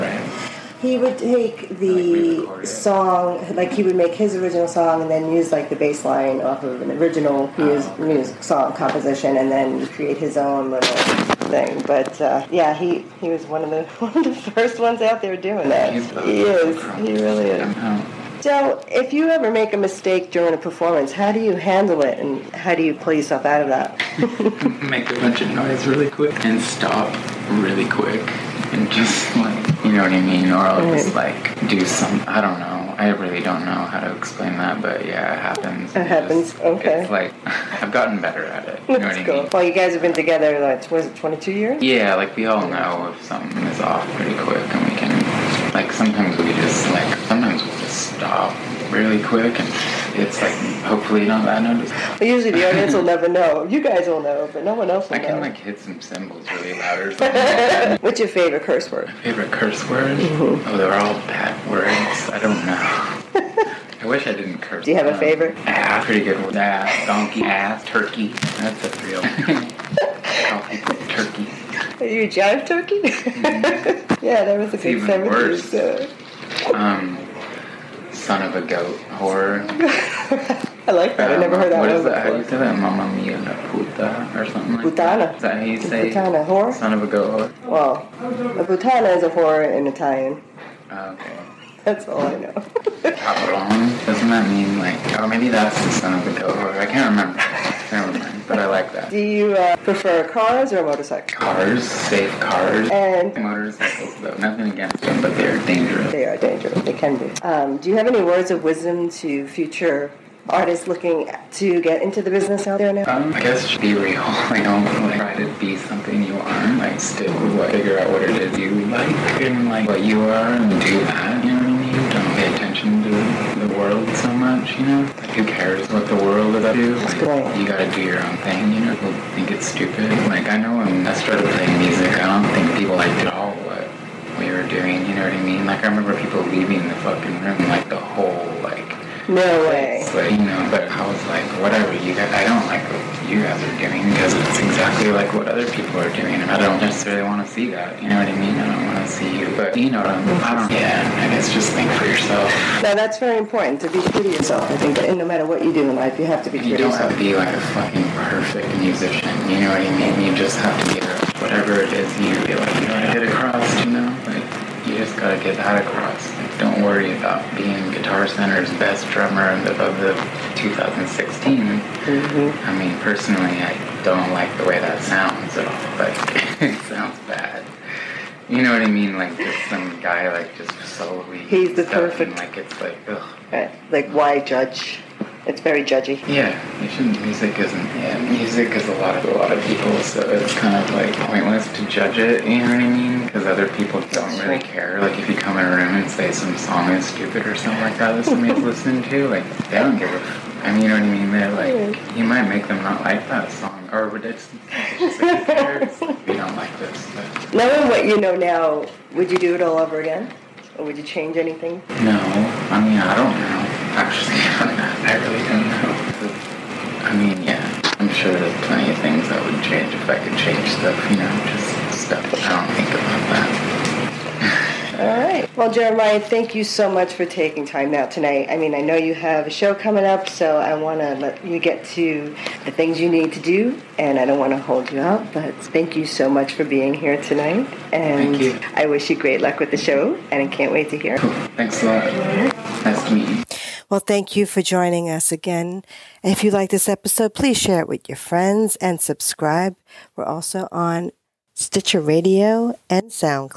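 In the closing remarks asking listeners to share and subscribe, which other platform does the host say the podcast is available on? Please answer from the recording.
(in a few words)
Stitcher Radio.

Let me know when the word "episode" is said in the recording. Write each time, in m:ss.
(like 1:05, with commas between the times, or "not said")
4:06.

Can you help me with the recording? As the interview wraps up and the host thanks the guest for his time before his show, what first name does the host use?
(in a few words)
Jeremiah.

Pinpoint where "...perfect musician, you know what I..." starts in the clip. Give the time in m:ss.
2:38.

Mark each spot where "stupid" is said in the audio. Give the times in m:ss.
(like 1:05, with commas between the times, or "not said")
2:09, 3:17.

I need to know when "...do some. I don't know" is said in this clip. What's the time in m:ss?
0:31.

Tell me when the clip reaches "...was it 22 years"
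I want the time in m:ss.
0:40.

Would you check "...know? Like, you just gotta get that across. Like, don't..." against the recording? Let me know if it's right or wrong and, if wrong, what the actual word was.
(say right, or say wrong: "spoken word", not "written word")
right.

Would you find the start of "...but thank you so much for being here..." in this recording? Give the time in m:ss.
3:55.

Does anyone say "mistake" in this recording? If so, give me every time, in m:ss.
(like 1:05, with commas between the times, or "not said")
0:19.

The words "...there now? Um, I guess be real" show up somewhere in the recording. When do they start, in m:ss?
1:52.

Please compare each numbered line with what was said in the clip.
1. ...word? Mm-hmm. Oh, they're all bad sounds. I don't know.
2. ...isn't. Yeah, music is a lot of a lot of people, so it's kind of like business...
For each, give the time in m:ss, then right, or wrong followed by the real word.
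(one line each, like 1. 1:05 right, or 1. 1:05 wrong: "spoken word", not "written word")
1. 0:59 wrong: "words", not "sounds"
2. 3:07 wrong: "pointless", not "business".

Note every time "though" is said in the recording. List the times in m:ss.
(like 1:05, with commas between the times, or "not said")
1:44.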